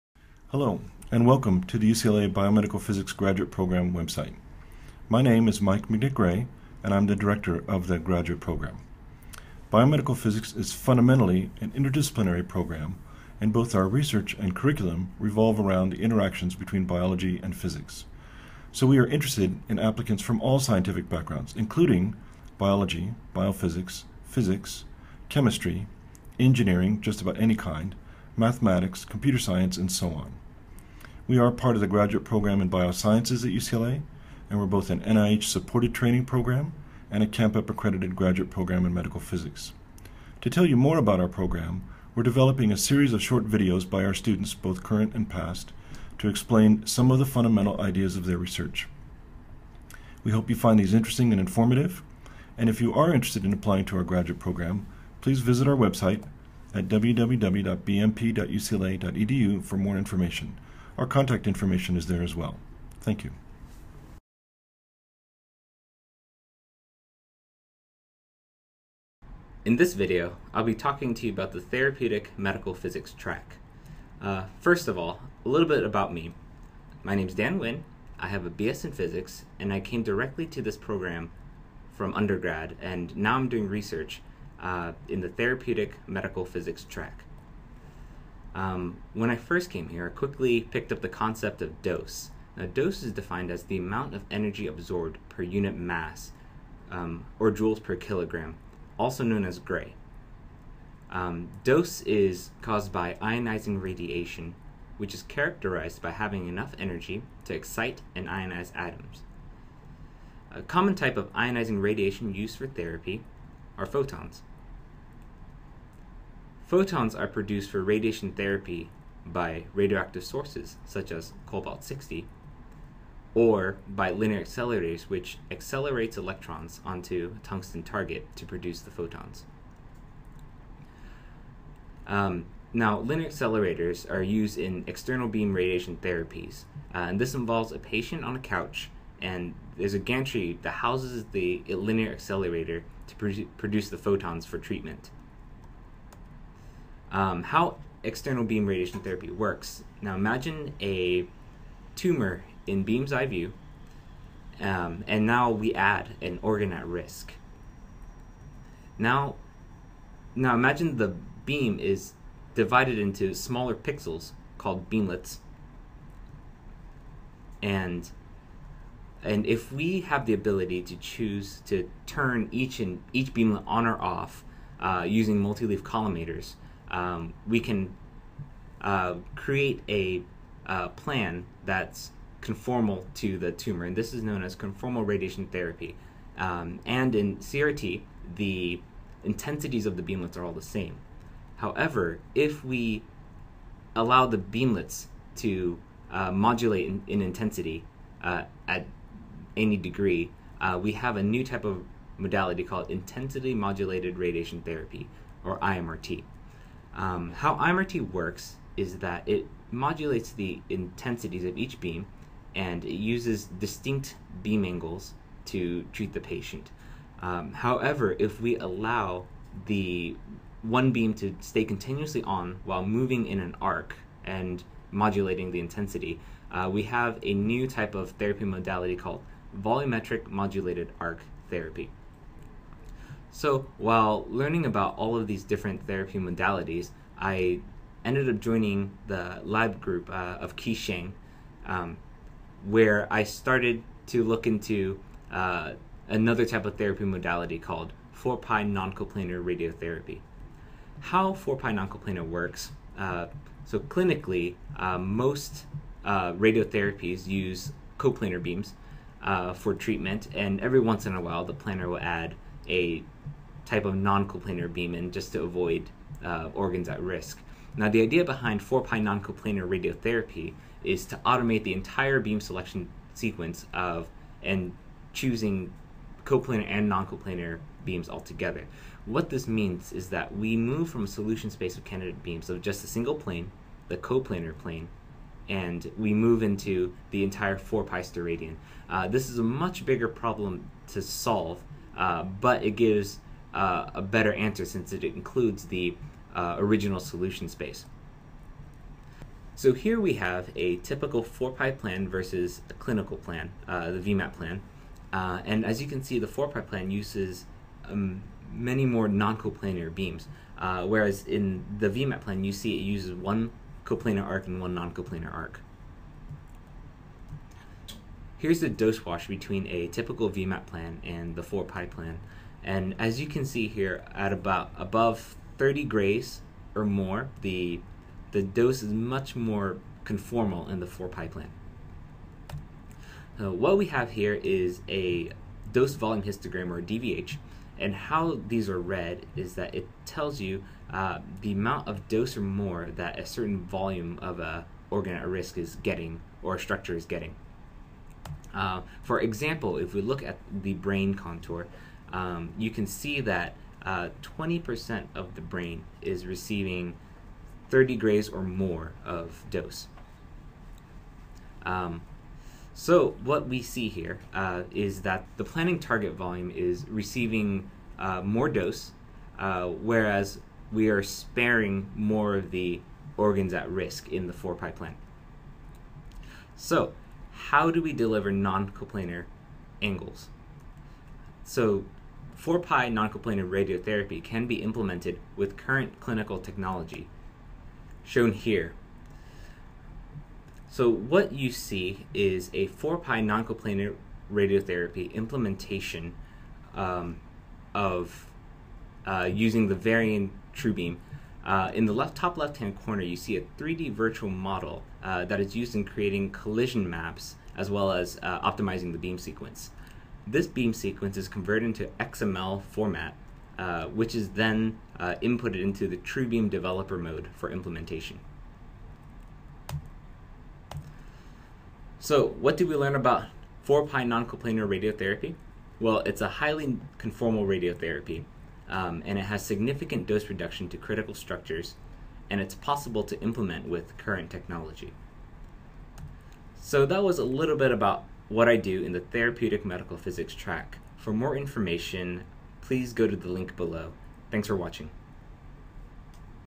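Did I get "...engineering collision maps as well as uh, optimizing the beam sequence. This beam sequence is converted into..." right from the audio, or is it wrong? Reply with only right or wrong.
wrong.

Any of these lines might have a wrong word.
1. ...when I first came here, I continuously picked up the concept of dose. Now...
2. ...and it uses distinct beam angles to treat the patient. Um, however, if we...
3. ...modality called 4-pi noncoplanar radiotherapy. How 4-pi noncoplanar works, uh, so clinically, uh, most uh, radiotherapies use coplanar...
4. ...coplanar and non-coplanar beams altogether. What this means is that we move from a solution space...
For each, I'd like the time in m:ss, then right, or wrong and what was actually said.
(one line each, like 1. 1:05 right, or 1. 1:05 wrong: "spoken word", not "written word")
1. 1:29 wrong: "quickly", not "continuously"
2. 3:32 right
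3. 4:07 right
4. 4:36 right.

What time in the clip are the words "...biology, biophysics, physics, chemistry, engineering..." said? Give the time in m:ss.
0:22.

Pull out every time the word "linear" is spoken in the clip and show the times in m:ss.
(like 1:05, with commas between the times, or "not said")
2:04, 2:13, 2:21.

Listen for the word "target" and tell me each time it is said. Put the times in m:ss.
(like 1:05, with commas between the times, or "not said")
2:07, 6:05.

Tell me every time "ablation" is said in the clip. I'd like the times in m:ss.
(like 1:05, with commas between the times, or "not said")
not said.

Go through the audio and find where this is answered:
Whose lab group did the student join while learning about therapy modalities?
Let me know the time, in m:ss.
4:00.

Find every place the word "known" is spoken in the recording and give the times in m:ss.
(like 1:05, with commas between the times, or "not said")
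1:39, 3:04.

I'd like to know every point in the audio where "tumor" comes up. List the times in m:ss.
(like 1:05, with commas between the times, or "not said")
2:31, 3:03.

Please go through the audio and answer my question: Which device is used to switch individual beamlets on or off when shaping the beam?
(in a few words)
Multi-leaf collimators.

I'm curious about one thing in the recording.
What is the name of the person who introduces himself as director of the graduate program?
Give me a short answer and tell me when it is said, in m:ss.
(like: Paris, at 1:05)
Mike McNick, at 0:05.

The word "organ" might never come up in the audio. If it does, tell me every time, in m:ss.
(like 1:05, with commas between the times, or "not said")
2:36, 4:26, 5:44, 6:13.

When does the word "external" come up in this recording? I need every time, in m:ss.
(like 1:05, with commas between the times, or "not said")
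2:14, 2:28.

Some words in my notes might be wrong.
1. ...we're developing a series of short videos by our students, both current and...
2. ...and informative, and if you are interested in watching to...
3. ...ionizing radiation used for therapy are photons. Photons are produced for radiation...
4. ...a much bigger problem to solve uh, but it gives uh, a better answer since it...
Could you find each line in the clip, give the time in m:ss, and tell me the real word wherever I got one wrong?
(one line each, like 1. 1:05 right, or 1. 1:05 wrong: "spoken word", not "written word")
1. 0:42 right
2. 0:51 wrong: "applying", not "watching"
3. 1:51 right
4. 4:49 right.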